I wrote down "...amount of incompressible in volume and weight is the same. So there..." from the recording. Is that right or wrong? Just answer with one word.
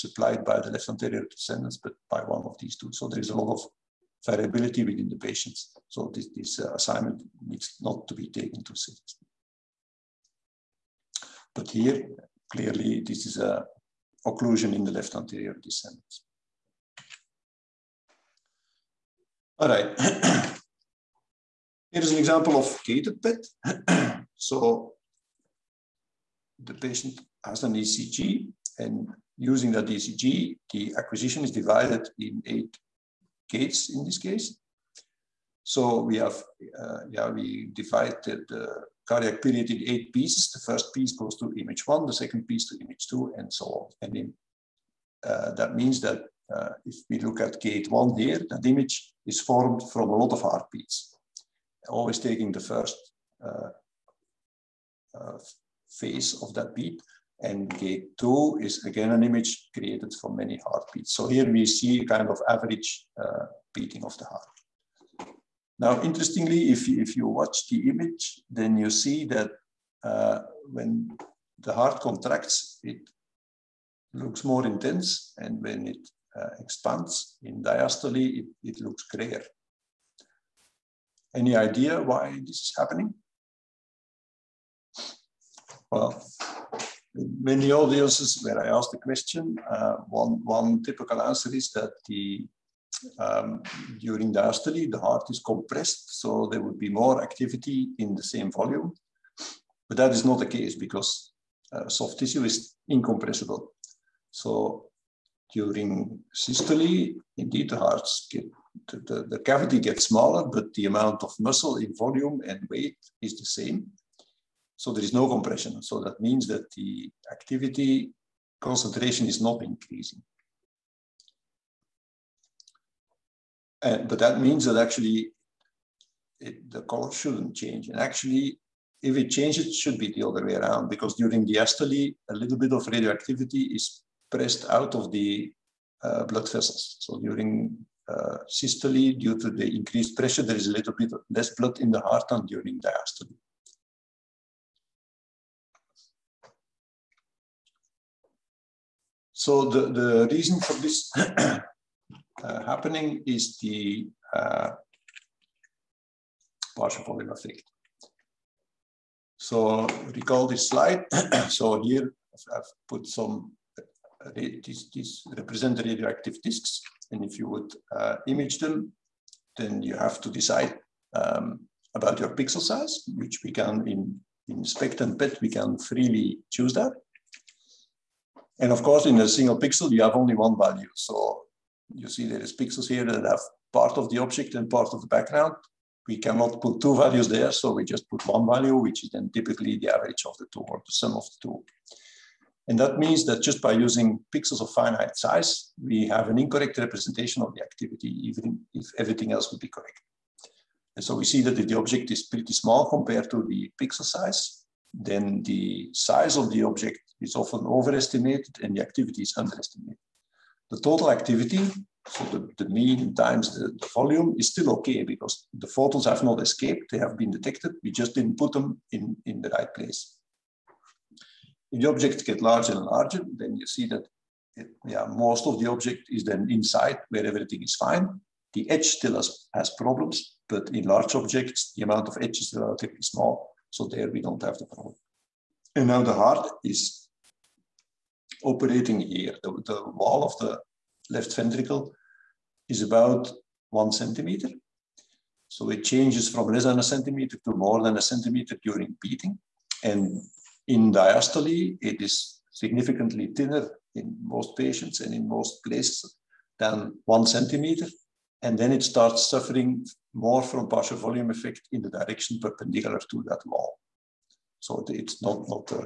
wrong.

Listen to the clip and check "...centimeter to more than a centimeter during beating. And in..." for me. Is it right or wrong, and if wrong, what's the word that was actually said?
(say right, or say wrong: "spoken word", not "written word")
right.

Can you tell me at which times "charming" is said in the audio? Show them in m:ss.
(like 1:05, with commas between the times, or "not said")
not said.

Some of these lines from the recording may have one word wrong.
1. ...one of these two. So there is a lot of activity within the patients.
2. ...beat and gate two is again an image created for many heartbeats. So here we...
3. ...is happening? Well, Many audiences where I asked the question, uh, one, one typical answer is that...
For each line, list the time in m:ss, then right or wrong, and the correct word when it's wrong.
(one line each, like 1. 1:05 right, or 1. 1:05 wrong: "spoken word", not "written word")
1. 0:02 wrong: "variability", not "activity"
2. 0:56 right
3. 1:22 right.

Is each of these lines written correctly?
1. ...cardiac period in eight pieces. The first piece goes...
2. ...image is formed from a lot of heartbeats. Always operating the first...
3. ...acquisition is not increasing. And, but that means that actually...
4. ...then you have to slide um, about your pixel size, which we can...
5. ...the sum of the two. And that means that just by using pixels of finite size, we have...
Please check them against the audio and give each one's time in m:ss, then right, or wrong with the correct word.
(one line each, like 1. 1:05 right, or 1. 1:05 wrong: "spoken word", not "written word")
1. 0:39 right
2. 0:48 wrong: "taking", not "operating"
3. 1:58 wrong: "concentration", not "acquisition"
4. 2:49 wrong: "decide", not "slide"
5. 3:10 right.